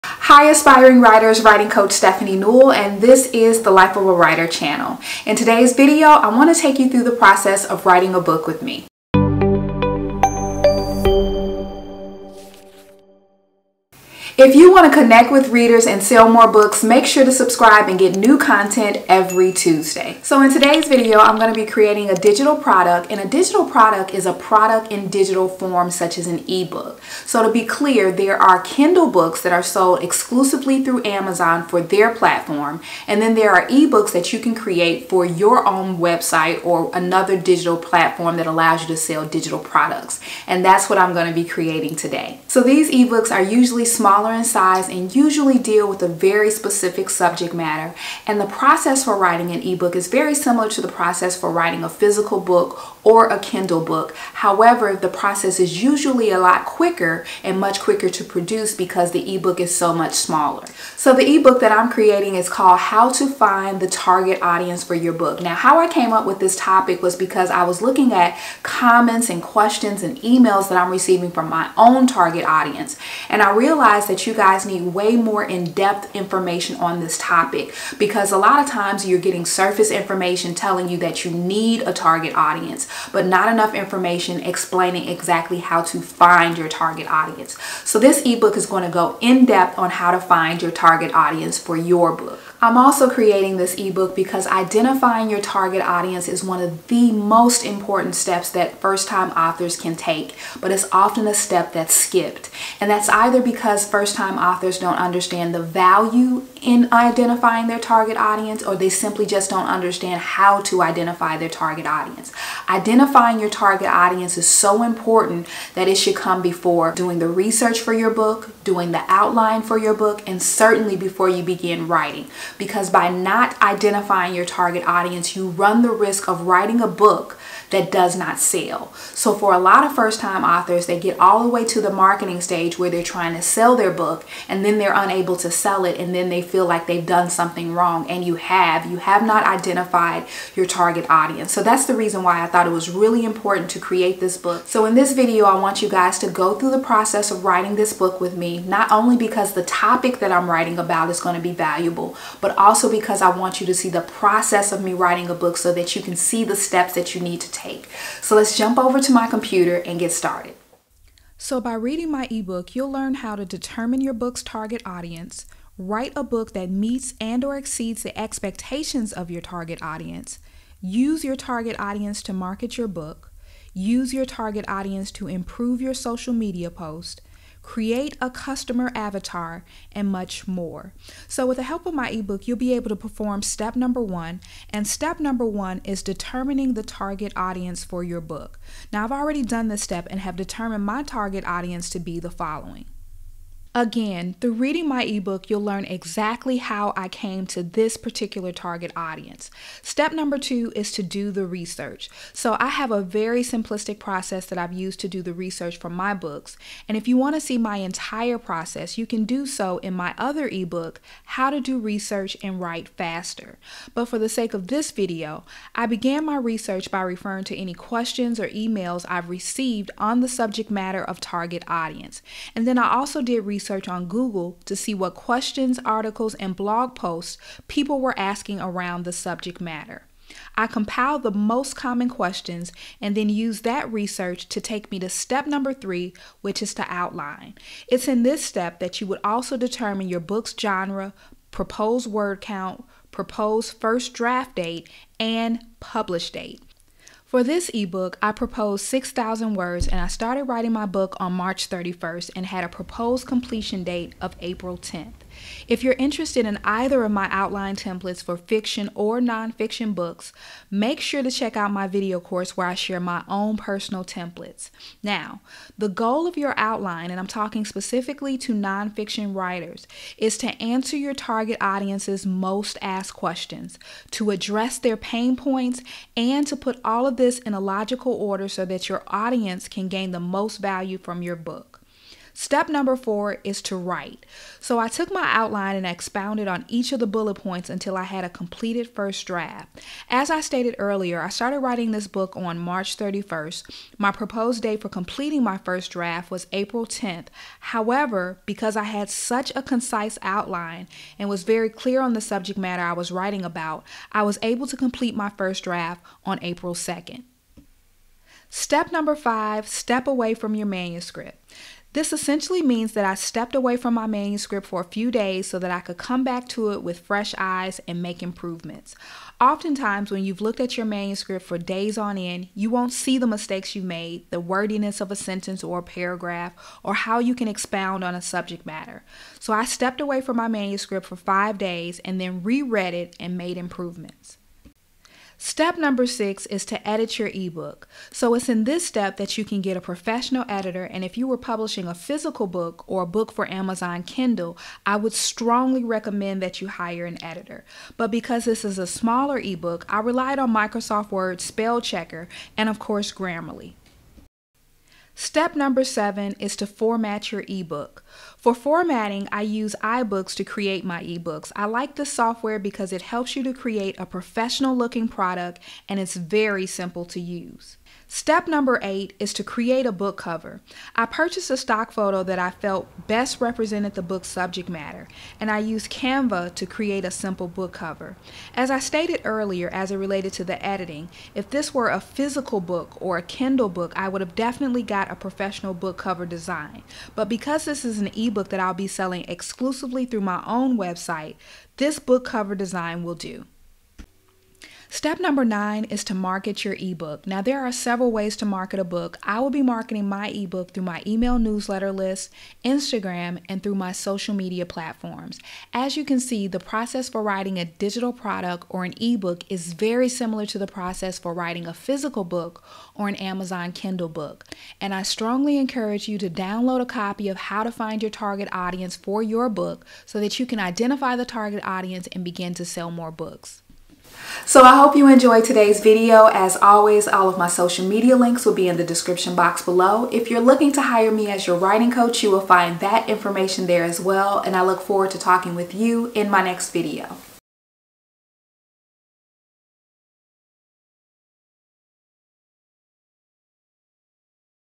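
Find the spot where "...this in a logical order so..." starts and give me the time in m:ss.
4:37.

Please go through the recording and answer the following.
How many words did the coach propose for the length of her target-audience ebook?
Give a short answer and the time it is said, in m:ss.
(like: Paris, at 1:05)
6,000, at 4:08.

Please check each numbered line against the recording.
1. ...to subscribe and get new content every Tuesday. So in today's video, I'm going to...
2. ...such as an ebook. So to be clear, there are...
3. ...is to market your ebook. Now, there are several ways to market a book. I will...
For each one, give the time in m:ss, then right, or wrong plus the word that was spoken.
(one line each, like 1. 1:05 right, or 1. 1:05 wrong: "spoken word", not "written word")
1. 0:17 right
2. 0:25 right
3. 6:35 right.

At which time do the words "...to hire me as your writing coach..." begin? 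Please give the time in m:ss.
7:10.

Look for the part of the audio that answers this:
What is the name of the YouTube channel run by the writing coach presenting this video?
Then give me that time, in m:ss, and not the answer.
0:03.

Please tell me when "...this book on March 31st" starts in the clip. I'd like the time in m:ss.
4:51.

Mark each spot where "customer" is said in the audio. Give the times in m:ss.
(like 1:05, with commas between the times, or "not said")
2:58.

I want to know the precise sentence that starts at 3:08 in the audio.
Now, I've already done this step and have determined my target audience to be the following.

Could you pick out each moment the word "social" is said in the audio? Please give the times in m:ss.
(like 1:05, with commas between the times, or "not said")
2:55, 6:43, 7:07.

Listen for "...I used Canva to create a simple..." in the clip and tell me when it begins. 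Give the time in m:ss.
6:15.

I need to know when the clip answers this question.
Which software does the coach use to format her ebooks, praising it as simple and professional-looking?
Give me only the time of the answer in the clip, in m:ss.
5:59.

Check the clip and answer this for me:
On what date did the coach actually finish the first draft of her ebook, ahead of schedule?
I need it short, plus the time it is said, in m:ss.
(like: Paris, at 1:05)
April 2nd, at 5:06.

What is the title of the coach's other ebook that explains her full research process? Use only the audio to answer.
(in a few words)
How to Do Research and Write Faster.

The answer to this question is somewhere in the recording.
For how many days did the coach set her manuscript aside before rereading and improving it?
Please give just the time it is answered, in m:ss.
5:31.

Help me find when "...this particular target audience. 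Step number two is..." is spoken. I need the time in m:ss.
3:17.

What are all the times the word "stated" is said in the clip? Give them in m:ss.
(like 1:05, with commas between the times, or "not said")
4:50, 6:18.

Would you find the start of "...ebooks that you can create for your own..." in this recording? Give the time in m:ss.
0:33.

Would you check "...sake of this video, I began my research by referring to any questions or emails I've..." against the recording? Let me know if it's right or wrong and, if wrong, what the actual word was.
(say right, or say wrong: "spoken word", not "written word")
right.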